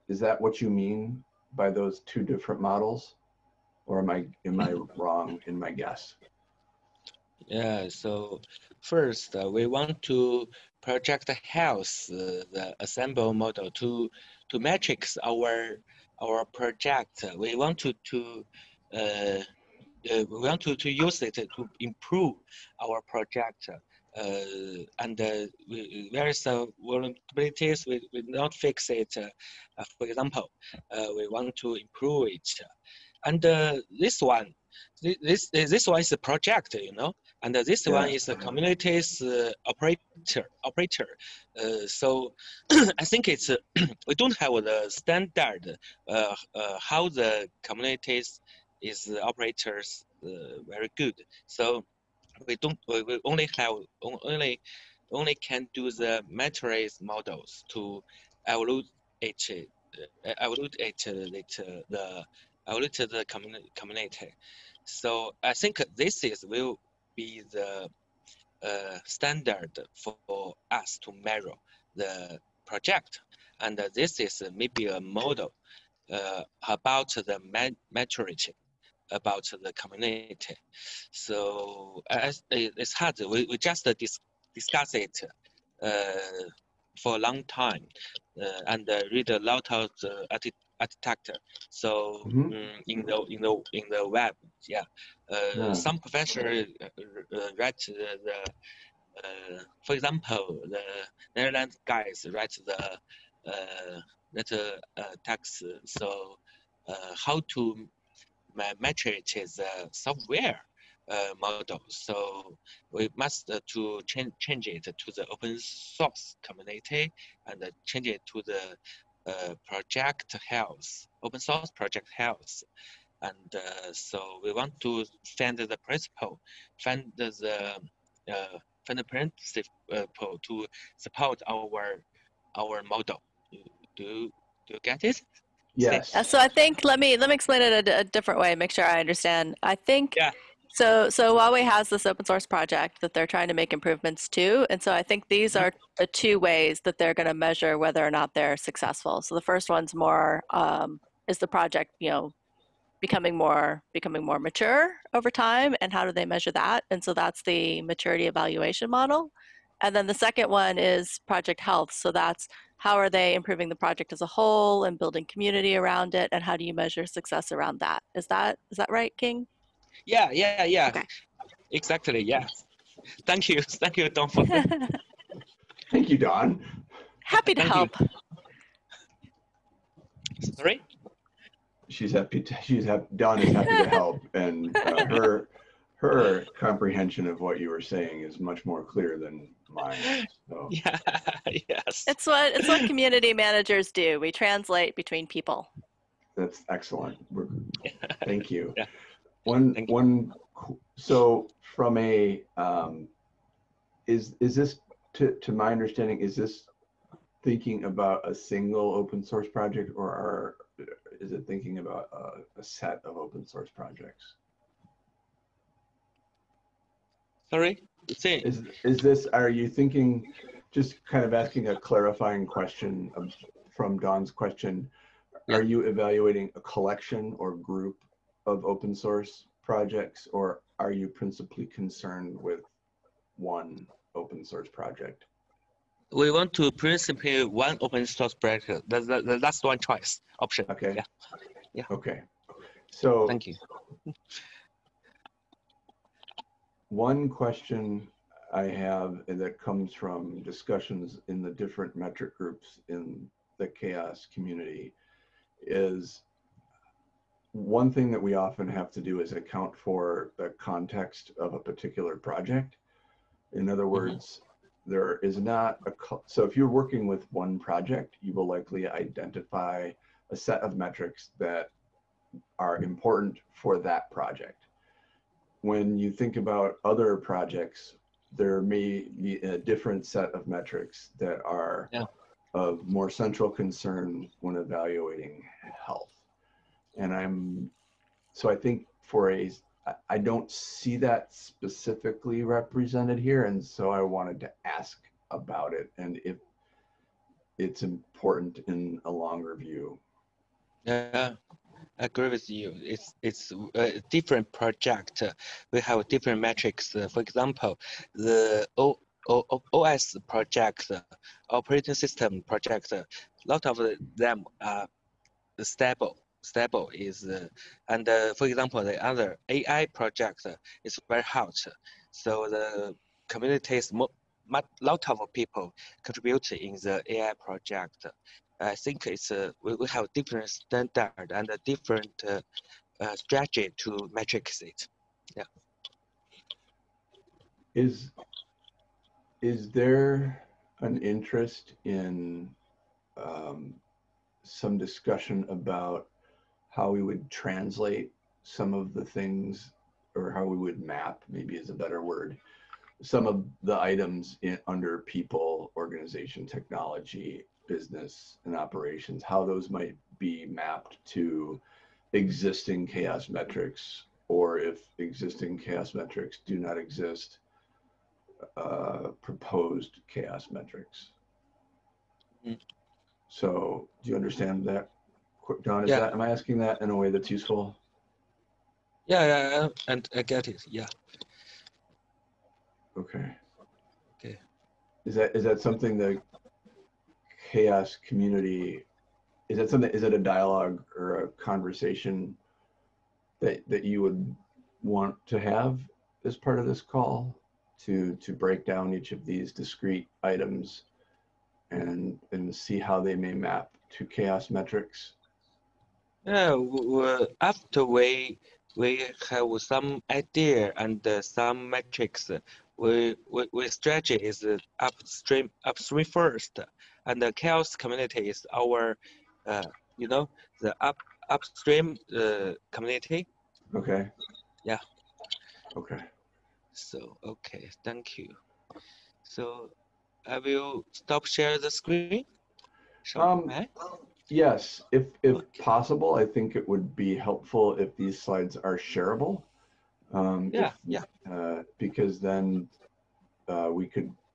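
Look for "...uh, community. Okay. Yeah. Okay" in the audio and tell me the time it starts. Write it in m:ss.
7:02.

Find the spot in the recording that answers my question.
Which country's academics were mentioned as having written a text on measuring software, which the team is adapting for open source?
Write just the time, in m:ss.
1:41.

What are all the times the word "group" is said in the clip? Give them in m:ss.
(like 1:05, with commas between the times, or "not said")
3:47, 4:12.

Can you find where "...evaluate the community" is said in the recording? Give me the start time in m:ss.
1:02.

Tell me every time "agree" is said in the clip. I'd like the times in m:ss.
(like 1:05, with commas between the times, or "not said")
5:01.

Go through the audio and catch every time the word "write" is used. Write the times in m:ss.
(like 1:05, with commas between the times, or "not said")
1:37, 1:42.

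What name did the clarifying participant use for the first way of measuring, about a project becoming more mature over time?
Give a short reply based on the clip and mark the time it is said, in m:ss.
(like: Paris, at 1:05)
maturity evaluation model, at 2:37.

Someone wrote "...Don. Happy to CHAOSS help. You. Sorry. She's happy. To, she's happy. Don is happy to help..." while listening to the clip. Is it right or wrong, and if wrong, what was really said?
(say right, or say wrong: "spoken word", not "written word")
wrong: "Thank", not "CHAOSS".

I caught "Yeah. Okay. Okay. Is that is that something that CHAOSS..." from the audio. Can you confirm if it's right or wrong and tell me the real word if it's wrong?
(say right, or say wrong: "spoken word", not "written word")
right.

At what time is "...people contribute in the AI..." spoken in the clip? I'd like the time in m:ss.
5:25.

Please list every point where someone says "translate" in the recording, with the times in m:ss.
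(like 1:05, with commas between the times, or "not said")
3:14, 5:47.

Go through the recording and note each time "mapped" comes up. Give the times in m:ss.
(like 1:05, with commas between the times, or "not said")
6:00.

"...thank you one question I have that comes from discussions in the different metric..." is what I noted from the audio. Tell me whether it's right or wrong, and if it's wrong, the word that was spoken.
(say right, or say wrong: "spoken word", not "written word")
right.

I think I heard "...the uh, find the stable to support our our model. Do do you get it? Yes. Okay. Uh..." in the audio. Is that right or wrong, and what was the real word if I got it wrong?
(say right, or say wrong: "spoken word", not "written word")
wrong: "principle", not "stable".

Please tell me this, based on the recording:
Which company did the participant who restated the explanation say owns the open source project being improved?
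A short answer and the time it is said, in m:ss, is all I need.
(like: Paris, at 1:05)
Huawei, at 2:21.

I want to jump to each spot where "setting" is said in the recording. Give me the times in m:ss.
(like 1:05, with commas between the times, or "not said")
not said.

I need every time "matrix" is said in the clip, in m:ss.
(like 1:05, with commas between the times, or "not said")
0:14, 0:56.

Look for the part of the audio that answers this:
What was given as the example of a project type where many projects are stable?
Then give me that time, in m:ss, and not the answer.
5:11.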